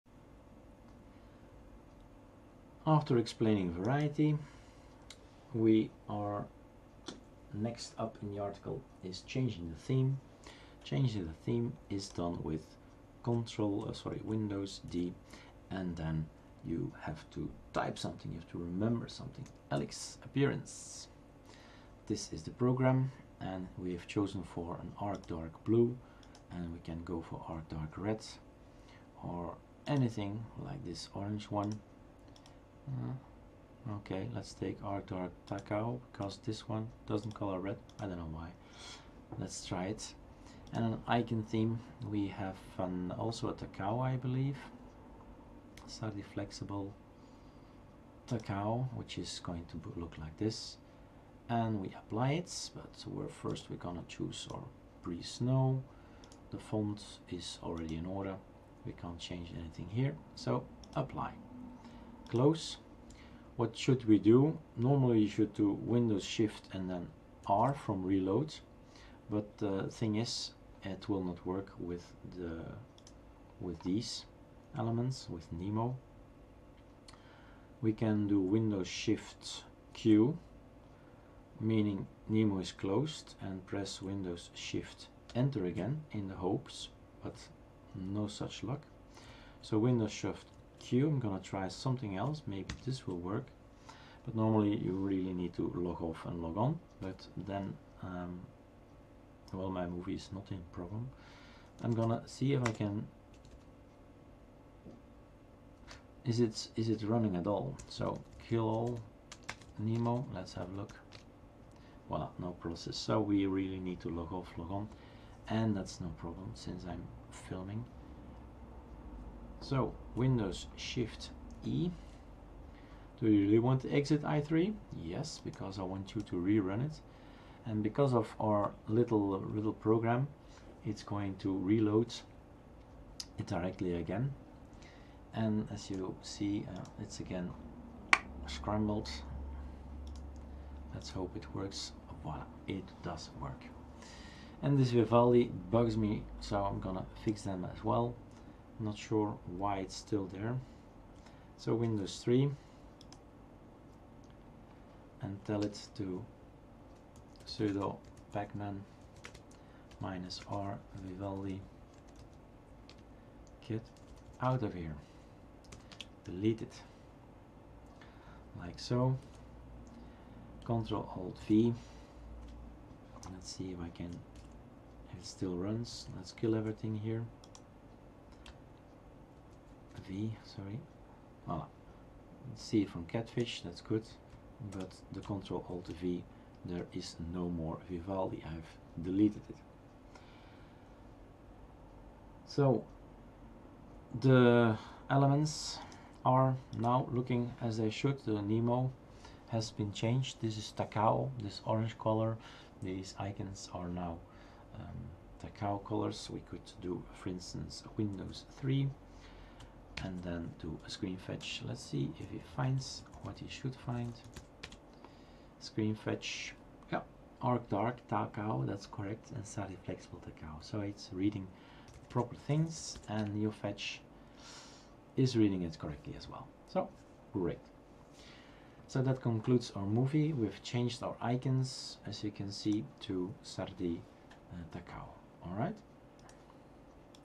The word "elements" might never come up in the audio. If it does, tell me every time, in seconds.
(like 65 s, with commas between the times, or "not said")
74 s, 195 s.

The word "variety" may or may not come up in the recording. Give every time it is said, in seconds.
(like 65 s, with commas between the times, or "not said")
3 s.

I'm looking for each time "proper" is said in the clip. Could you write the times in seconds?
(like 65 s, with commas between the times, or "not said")
222 s.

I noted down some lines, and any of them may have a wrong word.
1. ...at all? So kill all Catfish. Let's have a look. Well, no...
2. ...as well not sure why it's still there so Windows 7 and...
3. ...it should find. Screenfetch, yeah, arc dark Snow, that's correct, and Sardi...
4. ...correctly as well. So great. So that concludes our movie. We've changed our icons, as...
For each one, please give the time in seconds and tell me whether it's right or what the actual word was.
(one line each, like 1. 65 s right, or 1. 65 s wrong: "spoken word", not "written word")
1. 107 s wrong: "Nemo", not "Catfish"
2. 147 s wrong: "3", not "7"
3. 213 s wrong: "Takao", not "Snow"
4. 225 s right.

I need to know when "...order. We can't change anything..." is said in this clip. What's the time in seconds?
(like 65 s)
58 s.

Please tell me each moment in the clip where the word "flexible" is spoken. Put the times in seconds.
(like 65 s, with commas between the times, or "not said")
46 s, 219 s.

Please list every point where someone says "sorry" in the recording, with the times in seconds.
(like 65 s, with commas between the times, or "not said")
13 s, 180 s.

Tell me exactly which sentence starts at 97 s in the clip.
But then, um, well, my movie is not in problem.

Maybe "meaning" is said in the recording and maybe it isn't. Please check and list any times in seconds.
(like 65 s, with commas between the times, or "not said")
81 s.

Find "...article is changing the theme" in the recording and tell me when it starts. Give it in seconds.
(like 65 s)
8 s.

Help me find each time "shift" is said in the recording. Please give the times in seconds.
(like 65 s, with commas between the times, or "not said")
66 s, 78 s, 84 s, 90 s, 120 s.